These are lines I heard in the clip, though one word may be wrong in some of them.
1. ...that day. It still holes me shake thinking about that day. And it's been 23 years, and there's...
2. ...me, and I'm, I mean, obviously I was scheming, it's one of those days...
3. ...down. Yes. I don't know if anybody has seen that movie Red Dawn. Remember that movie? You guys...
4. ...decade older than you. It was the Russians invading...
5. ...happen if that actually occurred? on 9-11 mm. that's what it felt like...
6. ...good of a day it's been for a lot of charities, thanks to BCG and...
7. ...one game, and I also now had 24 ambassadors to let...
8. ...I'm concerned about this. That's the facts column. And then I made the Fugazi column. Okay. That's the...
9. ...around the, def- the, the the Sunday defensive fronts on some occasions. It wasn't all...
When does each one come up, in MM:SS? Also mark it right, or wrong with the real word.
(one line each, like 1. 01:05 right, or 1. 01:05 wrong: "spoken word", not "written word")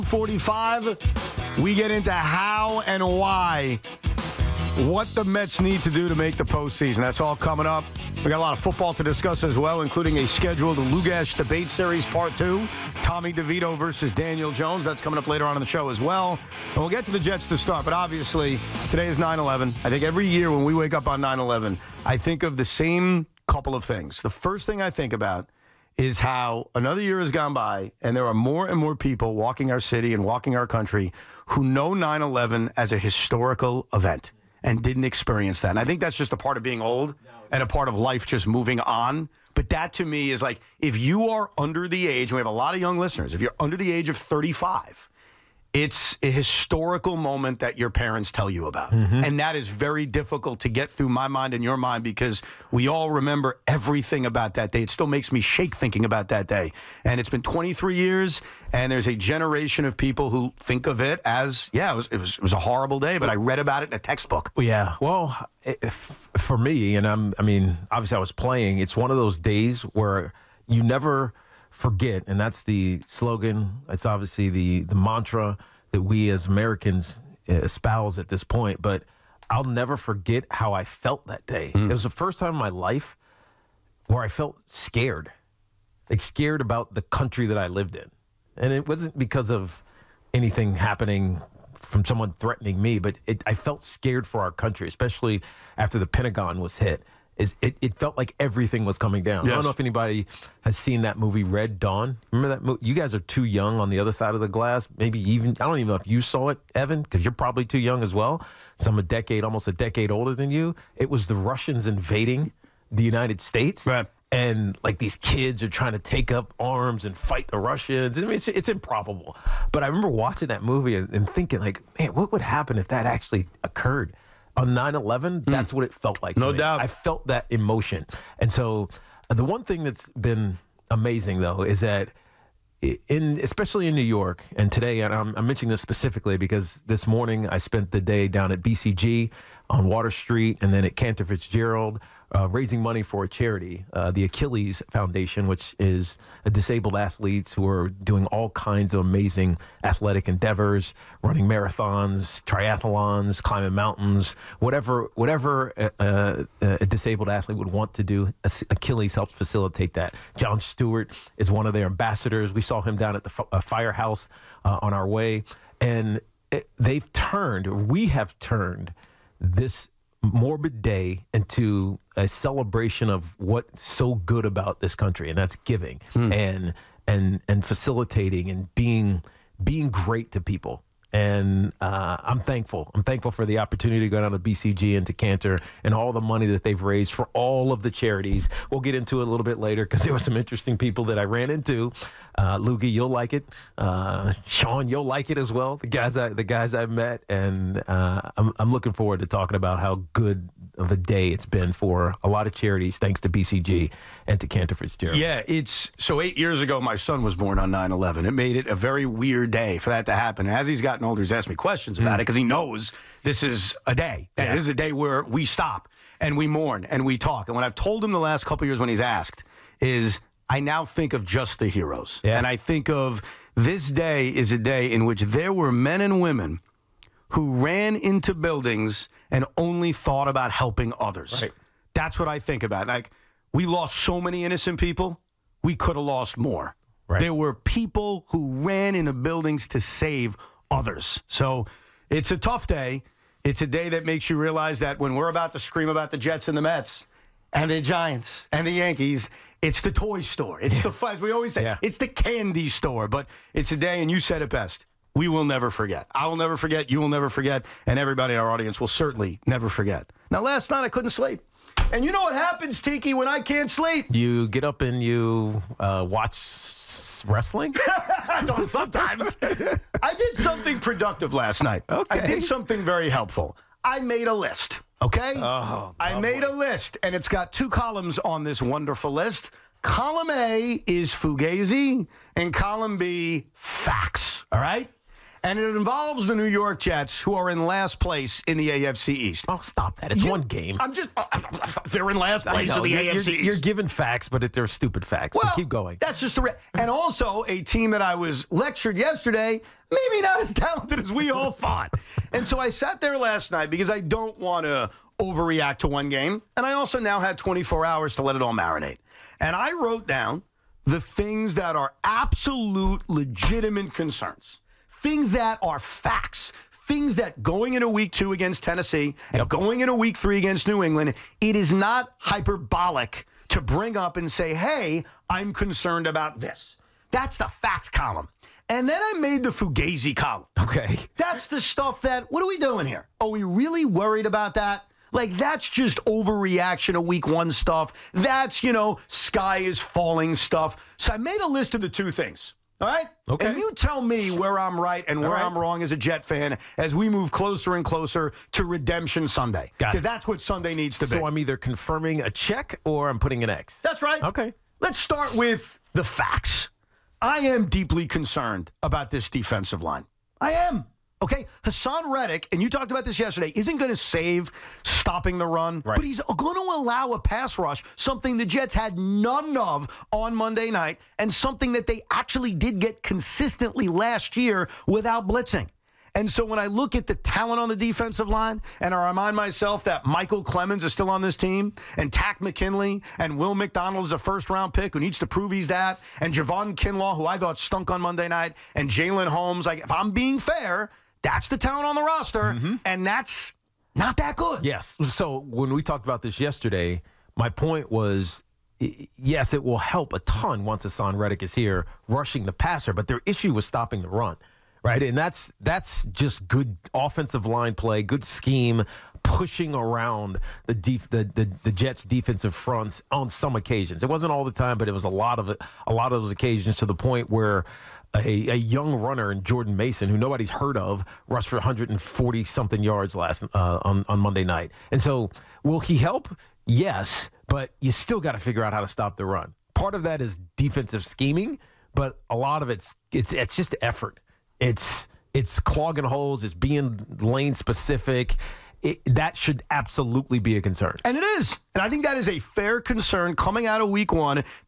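1. 00:54 wrong: "makes", not "holes"
2. 01:06 wrong: "playing", not "scheming"
3. 01:39 right
4. 01:49 right
5. 02:02 right
6. 03:20 right
7. 05:05 wrong: "hours", not "ambassadors"
8. 05:25 right
9. 06:49 wrong: "Jets", not "Sunday".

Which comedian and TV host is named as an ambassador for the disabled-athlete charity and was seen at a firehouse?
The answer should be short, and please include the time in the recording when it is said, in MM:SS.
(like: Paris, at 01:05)
Jon Stewart, at 02:40.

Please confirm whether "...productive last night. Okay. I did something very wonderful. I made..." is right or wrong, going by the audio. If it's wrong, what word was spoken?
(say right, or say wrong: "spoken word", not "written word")
wrong: "helpful", not "wonderful".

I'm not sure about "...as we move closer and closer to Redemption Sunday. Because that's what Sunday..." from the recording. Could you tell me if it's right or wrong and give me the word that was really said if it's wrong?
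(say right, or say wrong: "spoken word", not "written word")
right.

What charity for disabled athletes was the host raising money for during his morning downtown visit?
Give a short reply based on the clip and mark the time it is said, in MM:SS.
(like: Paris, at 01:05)
Achilles Foundation, at 02:24.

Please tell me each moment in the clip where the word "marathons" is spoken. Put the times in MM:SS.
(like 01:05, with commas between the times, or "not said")
02:31.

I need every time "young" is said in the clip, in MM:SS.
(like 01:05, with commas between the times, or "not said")
00:42, 01:43, 01:47, 06:58.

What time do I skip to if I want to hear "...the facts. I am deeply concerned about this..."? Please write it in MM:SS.
05:55.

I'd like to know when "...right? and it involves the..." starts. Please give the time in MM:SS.
04:44.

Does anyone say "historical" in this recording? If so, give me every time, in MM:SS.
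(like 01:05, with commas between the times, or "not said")
00:32, 00:46.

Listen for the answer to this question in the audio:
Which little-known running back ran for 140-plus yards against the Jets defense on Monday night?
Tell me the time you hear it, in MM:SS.
06:59.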